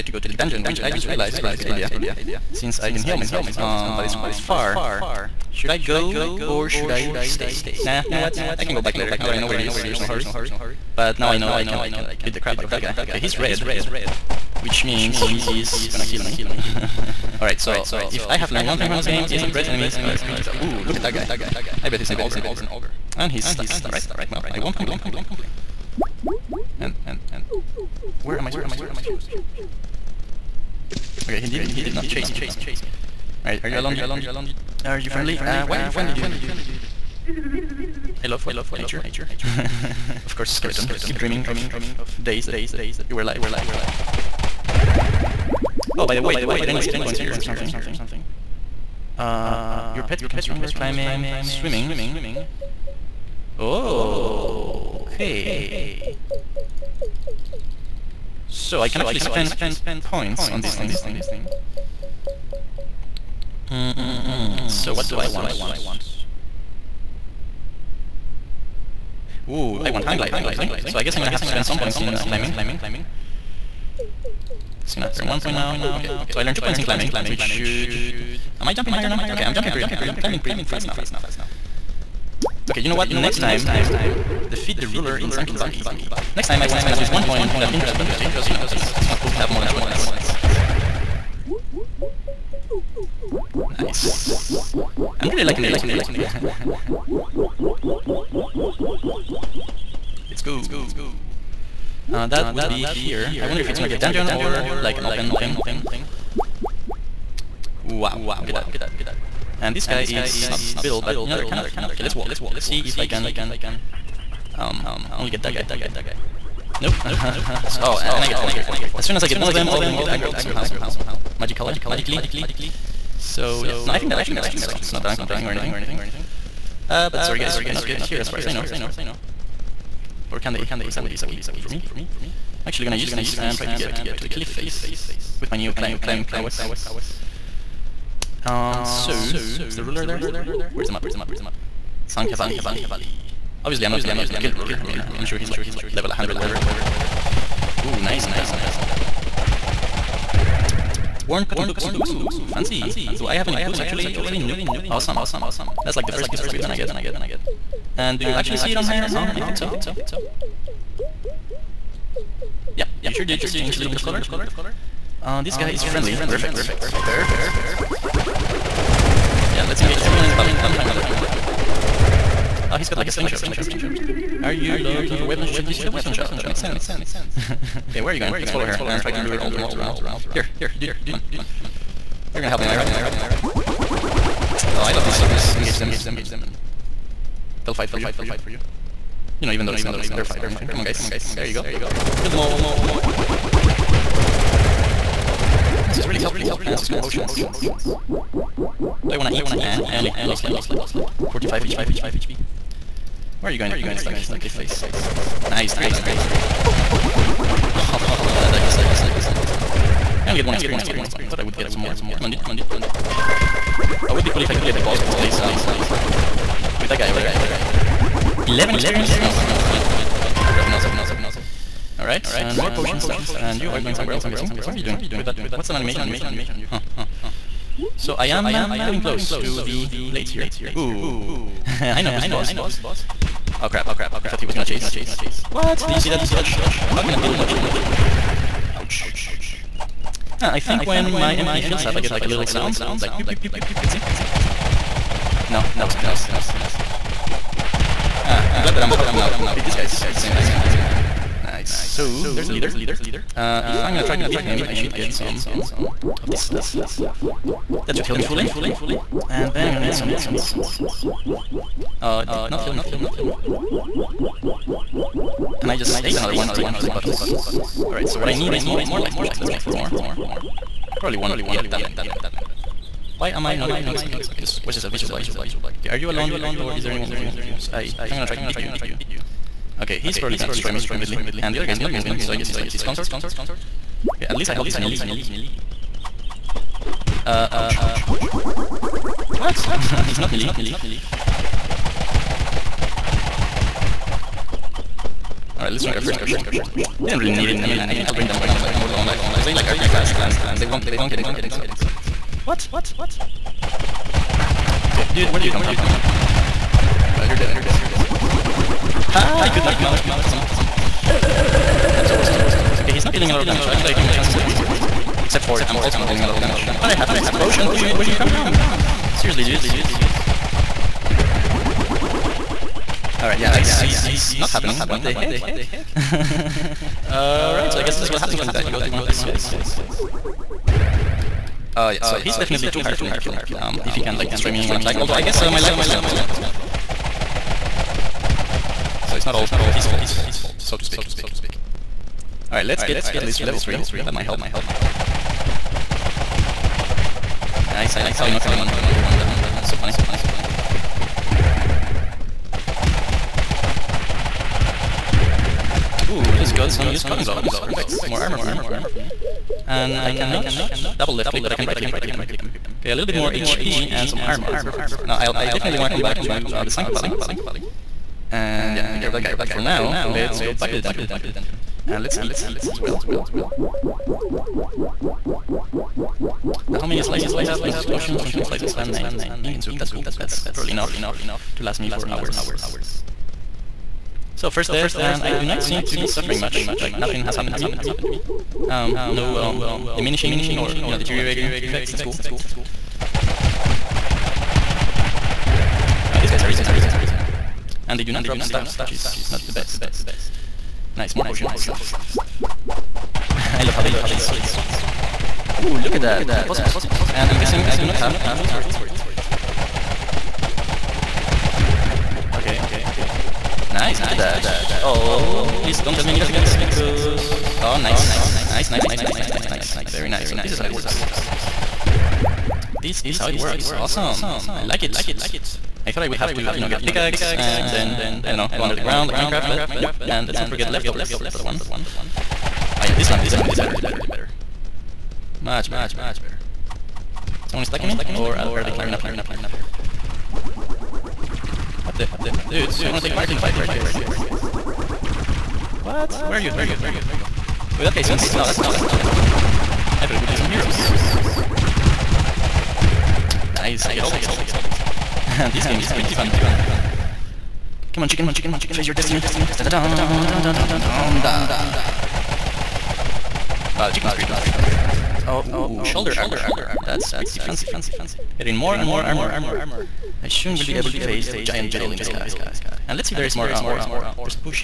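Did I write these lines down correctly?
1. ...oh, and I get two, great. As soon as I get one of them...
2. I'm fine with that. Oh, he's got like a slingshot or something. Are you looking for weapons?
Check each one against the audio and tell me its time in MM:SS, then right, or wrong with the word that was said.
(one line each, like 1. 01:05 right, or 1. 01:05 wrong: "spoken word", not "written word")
1. 01:57 wrong: "four", not "two"
2. 02:50 right.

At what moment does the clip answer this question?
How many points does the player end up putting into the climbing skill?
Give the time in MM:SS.
01:16.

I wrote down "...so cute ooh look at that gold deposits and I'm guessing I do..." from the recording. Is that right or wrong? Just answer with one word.
right.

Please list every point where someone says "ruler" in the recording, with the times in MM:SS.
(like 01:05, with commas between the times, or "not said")
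01:24, 02:19, 02:24.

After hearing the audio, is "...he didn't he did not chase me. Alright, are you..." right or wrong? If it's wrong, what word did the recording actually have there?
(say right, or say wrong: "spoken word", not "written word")
right.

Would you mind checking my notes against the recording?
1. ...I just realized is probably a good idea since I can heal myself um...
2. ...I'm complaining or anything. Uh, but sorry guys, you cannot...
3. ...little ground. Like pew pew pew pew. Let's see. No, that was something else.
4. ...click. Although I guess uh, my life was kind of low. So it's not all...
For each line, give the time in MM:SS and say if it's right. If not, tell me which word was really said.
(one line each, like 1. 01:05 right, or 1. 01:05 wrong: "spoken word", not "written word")
1. 00:00 right
2. 02:05 right
3. 04:02 wrong: "sound", not "ground"
4. 05:34 wrong: "attack", not "click".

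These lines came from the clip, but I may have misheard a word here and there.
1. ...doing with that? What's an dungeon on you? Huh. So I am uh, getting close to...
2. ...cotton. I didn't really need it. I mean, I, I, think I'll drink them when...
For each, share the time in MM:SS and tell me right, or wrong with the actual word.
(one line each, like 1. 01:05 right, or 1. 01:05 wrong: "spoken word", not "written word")
1. 03:44 wrong: "animation", not "dungeon"
2. 04:56 wrong: "potion", not "cotton".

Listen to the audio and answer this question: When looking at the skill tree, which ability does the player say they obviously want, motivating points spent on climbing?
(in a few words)
Hang gliding.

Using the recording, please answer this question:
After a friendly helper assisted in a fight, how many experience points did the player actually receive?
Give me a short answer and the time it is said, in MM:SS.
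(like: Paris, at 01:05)
1, at 03:30.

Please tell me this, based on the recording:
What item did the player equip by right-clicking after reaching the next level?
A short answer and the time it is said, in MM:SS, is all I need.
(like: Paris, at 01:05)
Used cotton gloves, at 05:56.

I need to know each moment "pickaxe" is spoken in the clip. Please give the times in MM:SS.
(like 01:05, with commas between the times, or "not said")
06:56, 07:06.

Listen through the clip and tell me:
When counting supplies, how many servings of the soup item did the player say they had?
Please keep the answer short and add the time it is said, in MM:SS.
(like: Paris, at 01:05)
9, at 06:18.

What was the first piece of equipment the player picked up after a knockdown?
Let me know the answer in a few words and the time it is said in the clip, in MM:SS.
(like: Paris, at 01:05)
Worn cotton boots, at 02:31.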